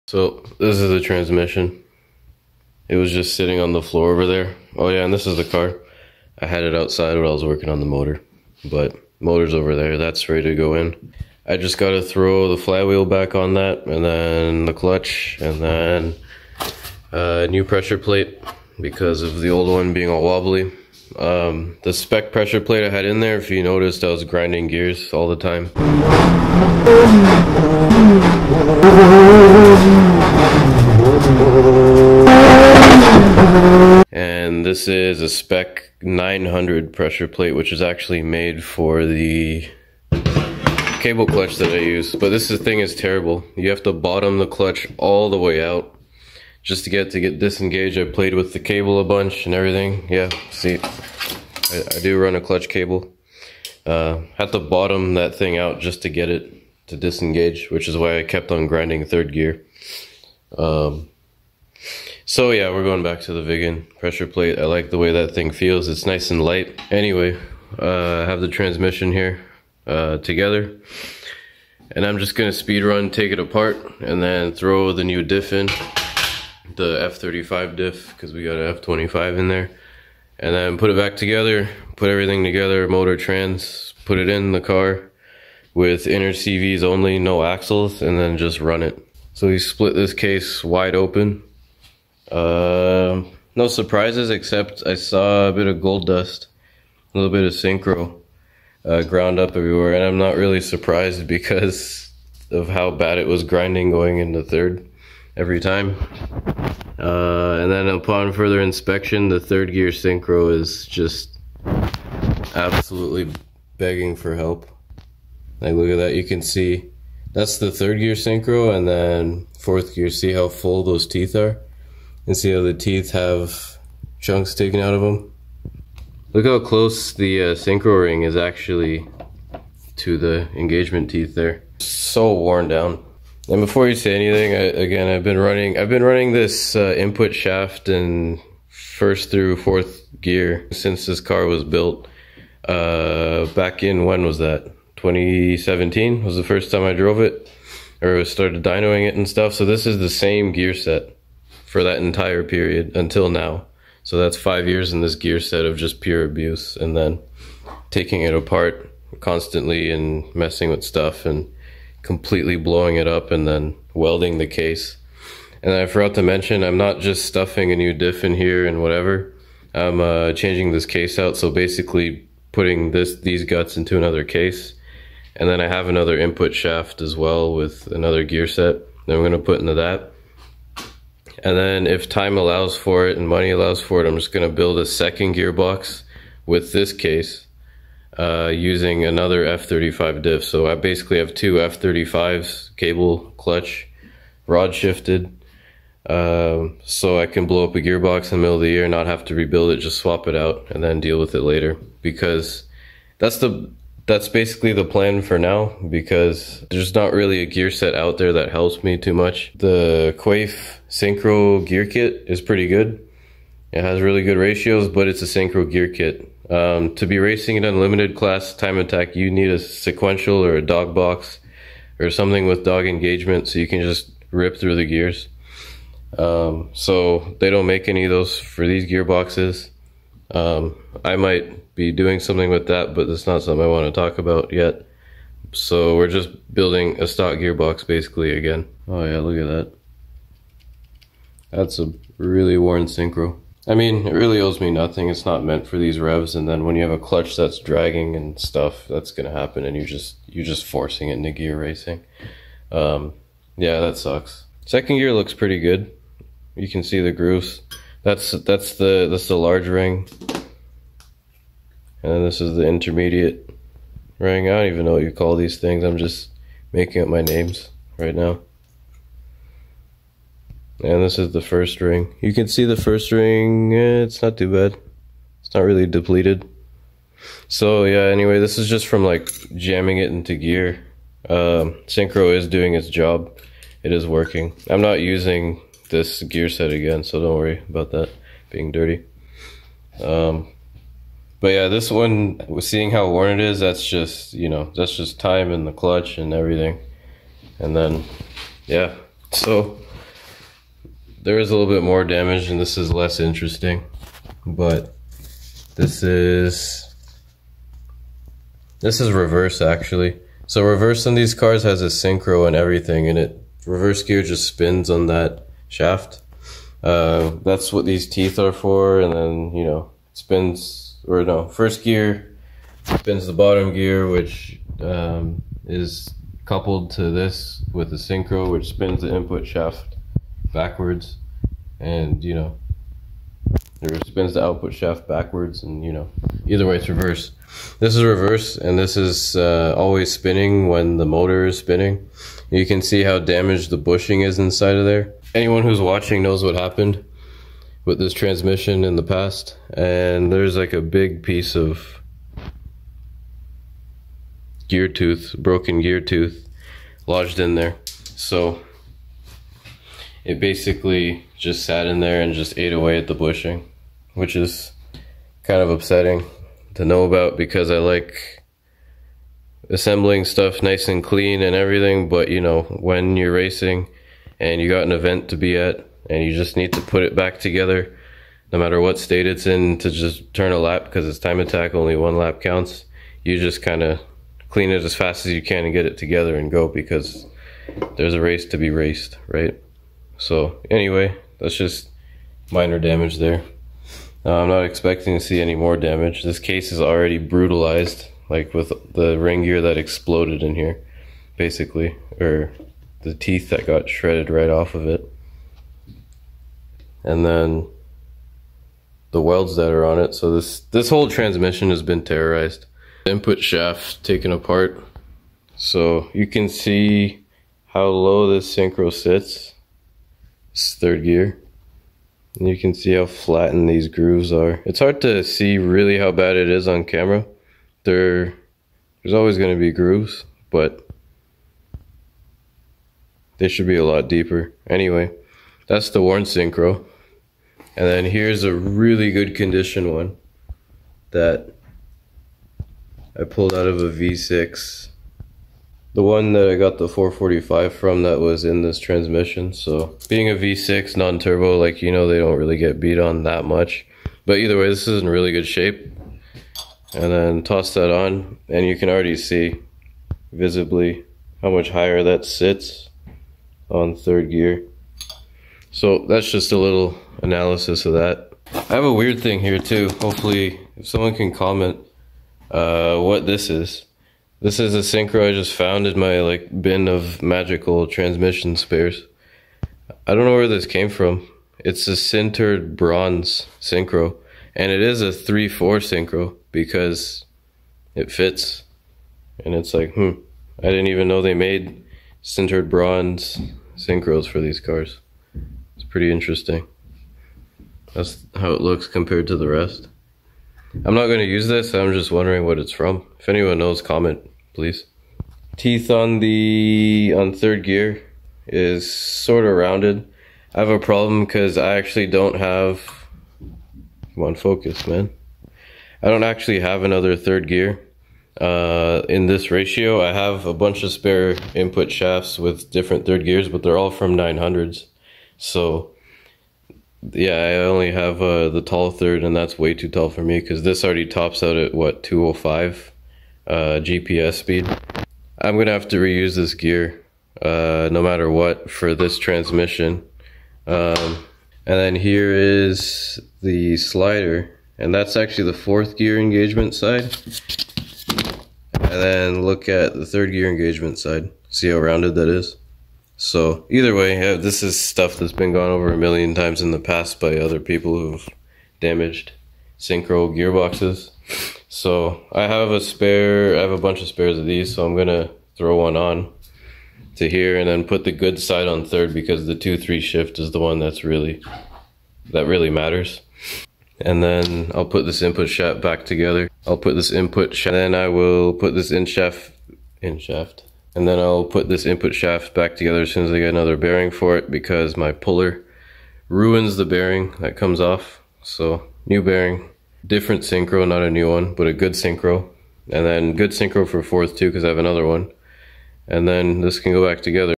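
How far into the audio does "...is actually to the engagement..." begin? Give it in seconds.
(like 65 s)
128 s.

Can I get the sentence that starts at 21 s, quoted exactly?
Um, the spec pressure plate I had in there, if you noticed, I was grinding gears all the time.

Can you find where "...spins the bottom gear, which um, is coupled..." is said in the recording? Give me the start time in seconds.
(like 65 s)
322 s.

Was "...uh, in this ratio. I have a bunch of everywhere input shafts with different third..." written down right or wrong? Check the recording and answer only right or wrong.
wrong.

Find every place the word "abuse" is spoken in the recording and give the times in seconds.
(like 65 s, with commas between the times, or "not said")
156 s.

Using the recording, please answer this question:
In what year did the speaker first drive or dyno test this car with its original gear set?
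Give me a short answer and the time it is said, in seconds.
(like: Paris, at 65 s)
2017, at 145 s.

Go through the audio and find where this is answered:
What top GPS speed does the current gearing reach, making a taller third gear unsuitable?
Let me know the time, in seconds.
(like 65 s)
532 s.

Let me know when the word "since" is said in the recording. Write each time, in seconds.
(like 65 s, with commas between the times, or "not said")
140 s.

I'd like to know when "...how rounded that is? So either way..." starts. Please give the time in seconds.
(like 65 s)
551 s.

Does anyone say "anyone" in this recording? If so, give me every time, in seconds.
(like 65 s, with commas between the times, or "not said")
345 s, 503 s.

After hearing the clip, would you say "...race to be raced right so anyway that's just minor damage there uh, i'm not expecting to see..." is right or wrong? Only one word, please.
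right.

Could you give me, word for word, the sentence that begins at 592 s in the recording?
And then good synchro for fourth too because I have another one.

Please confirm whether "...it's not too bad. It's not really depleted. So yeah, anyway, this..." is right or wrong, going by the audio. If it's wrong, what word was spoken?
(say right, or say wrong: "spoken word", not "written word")
right.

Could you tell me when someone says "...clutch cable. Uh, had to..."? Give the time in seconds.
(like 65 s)
52 s.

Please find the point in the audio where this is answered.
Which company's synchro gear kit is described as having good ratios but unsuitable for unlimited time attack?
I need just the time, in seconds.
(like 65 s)
210 s.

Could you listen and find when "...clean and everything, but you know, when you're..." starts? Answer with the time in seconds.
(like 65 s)
371 s.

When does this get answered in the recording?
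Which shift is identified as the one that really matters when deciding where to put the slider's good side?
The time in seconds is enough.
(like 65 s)
569 s.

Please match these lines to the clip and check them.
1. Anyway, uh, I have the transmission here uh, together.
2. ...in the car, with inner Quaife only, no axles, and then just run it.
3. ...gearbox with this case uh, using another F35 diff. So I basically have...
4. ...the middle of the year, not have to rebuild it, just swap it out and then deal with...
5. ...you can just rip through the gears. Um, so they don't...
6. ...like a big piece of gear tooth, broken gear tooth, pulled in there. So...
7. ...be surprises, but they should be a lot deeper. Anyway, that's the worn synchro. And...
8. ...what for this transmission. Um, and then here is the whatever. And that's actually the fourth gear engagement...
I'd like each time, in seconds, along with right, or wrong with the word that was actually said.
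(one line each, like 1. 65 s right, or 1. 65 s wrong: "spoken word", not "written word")
1. 66 s right
2. 84 s wrong: "CVs", not "Quaife"
3. 185 s right
4. 198 s right
5. 223 s right
6. 350 s wrong: "lodged", not "pulled"
7. 429 s wrong: "grooves", not "surprises"
8. 538 s wrong: "slider", not "whatever".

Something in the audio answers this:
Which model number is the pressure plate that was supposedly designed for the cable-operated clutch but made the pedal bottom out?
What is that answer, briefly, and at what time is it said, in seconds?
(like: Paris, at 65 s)
Spec 900, at 35 s.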